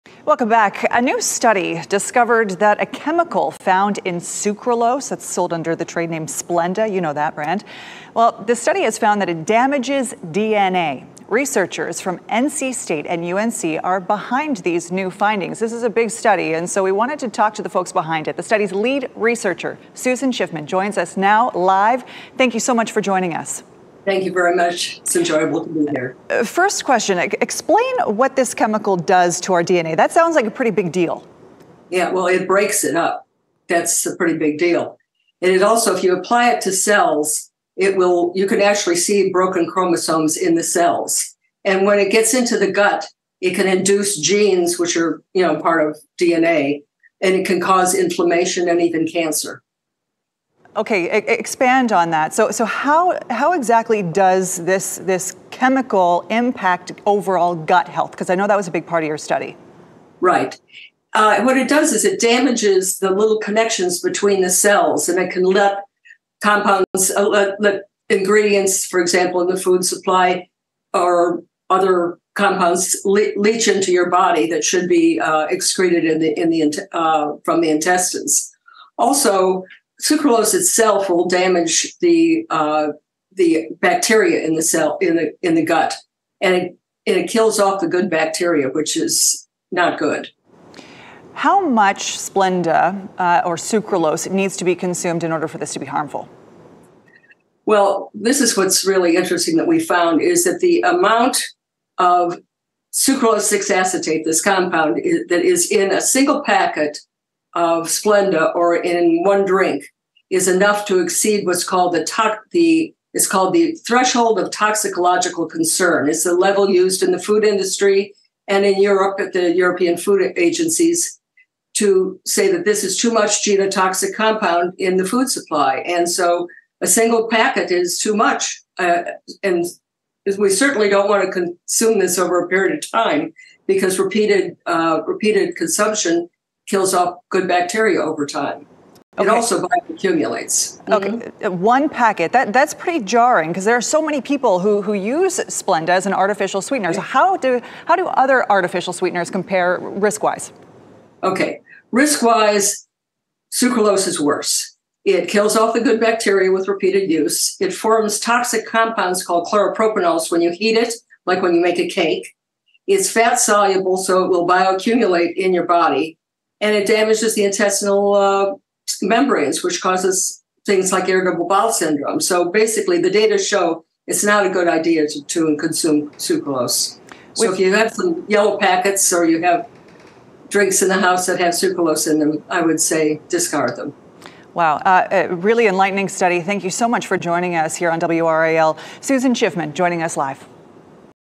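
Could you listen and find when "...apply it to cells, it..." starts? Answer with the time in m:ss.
0:36.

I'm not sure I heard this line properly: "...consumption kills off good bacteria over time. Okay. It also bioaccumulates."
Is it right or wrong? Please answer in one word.
right.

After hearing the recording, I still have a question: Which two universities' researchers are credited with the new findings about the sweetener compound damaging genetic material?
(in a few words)
NC State and UNC.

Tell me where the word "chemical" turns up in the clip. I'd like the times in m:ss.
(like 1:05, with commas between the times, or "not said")
0:02, 0:28, 0:55.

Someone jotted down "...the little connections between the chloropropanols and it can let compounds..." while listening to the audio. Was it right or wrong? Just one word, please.
wrong.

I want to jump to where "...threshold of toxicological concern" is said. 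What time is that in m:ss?
1:53.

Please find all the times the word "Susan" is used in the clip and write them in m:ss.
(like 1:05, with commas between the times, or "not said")
0:19, 3:08.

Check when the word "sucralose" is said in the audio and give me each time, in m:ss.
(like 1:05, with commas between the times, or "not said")
0:04, 1:20, 1:33, 1:42, 2:33, 2:56, 3:01.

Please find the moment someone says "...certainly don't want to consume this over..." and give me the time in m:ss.
2:10.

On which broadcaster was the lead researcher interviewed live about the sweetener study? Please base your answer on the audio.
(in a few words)
WRAL.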